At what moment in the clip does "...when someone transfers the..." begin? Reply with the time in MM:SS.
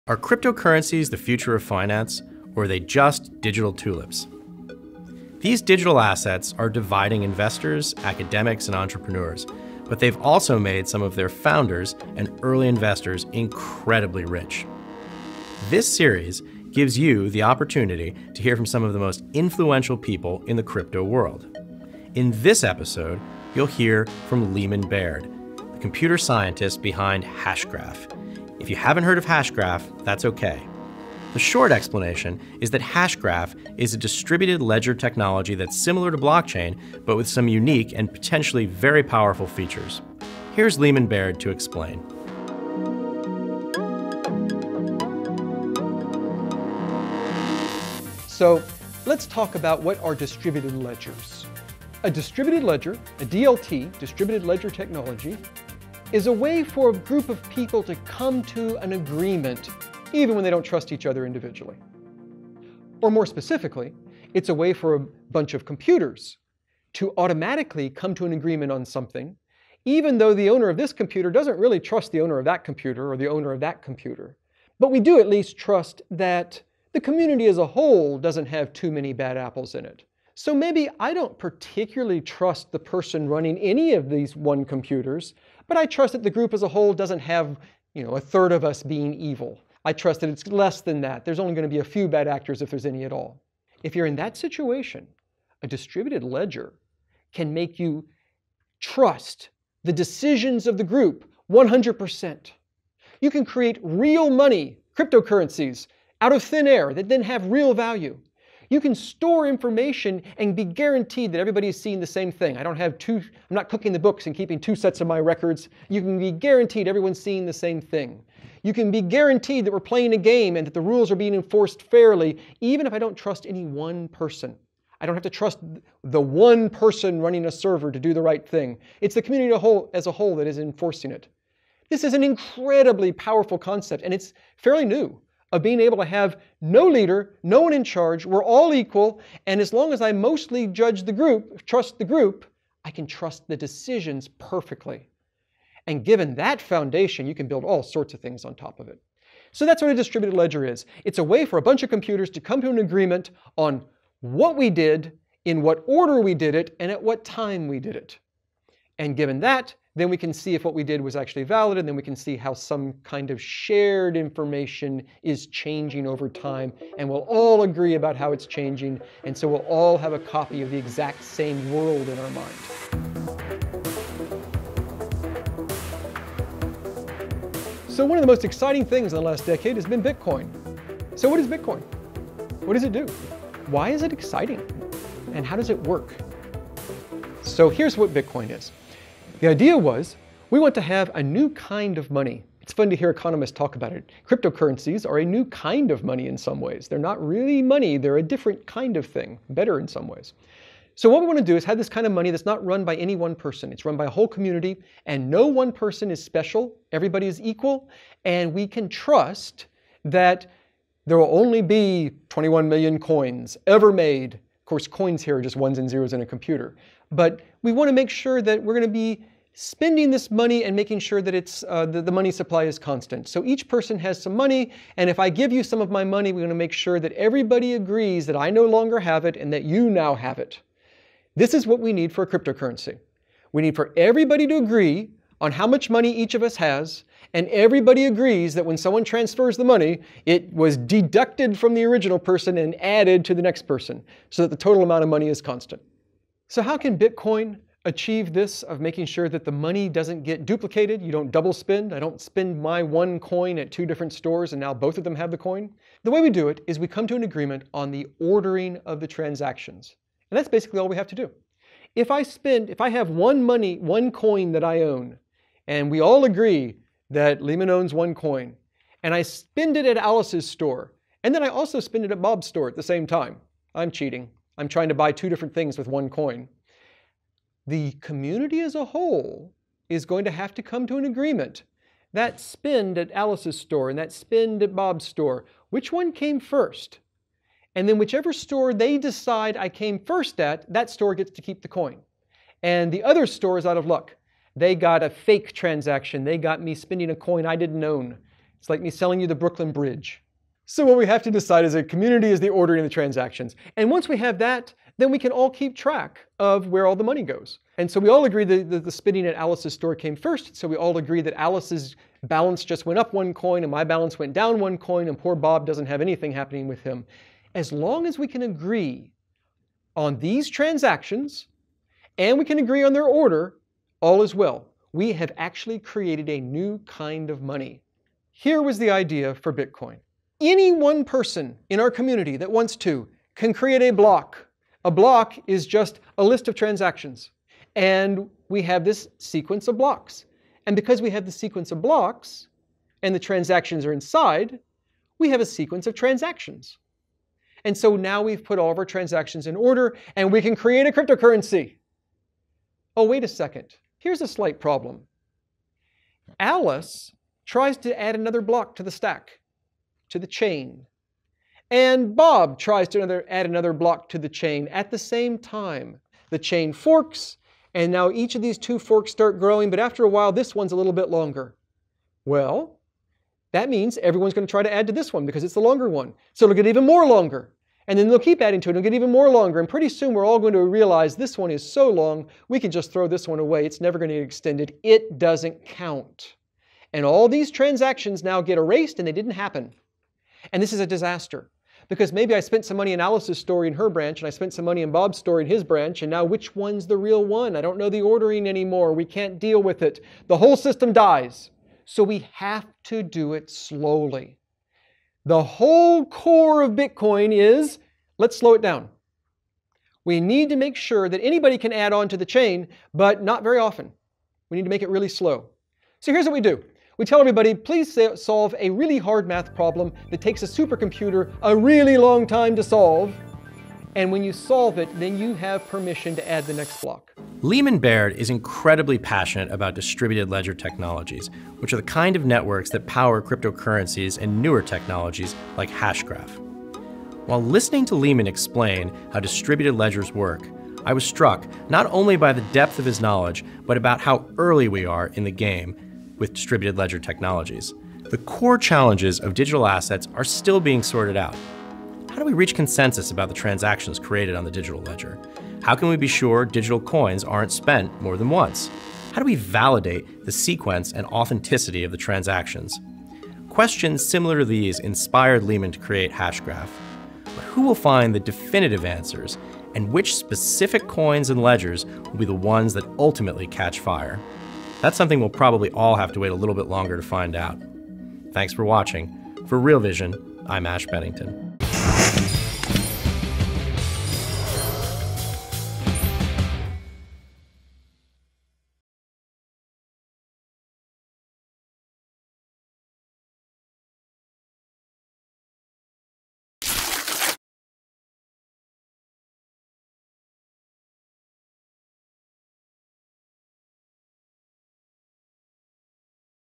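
03:58.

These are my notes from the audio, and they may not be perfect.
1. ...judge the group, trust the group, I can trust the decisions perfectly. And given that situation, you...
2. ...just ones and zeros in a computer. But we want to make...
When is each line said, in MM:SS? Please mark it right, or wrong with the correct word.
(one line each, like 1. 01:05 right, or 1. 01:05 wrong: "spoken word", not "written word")
1. 02:20 wrong: "foundation", not "situation"
2. 03:35 right.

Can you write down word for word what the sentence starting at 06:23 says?
It's never going to get extended.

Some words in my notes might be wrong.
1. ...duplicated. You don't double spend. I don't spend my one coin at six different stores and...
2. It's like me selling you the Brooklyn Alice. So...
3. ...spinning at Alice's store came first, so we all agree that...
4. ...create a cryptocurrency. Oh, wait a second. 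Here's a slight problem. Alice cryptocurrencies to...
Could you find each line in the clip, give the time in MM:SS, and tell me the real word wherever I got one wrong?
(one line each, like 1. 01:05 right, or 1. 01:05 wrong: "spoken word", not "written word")
1. 04:10 wrong: "two", not "six"
2. 04:58 wrong: "Bridge", not "Alice"
3. 05:08 right
4. 05:50 wrong: "tries", not "cryptocurrencies".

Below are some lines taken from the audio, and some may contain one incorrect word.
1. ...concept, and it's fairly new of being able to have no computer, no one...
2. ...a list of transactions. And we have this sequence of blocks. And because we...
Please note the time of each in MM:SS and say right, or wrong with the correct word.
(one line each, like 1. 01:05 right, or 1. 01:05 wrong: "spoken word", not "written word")
1. 02:13 wrong: "leader", not "computer"
2. 05:36 right.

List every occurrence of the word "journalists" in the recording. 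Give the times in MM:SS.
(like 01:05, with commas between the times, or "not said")
not said.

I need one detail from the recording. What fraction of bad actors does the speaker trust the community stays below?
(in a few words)
a third.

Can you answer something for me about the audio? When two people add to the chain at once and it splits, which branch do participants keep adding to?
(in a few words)
the longer one.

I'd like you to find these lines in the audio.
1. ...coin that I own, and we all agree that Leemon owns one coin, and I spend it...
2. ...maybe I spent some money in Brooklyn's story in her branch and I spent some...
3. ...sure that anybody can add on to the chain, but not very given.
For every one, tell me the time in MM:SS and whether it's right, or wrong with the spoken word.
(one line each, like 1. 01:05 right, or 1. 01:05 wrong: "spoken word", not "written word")
1. 04:24 right
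2. 06:32 wrong: "Alice", not "Brooklyn"
3. 06:50 wrong: "often", not "given".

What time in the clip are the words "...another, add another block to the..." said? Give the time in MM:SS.
06:02.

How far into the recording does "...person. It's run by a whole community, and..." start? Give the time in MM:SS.
03:23.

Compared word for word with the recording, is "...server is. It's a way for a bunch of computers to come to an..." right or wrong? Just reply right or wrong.
wrong.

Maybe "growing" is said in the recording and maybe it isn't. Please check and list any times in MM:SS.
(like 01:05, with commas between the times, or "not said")
06:09.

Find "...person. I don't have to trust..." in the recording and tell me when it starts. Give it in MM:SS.
02:04.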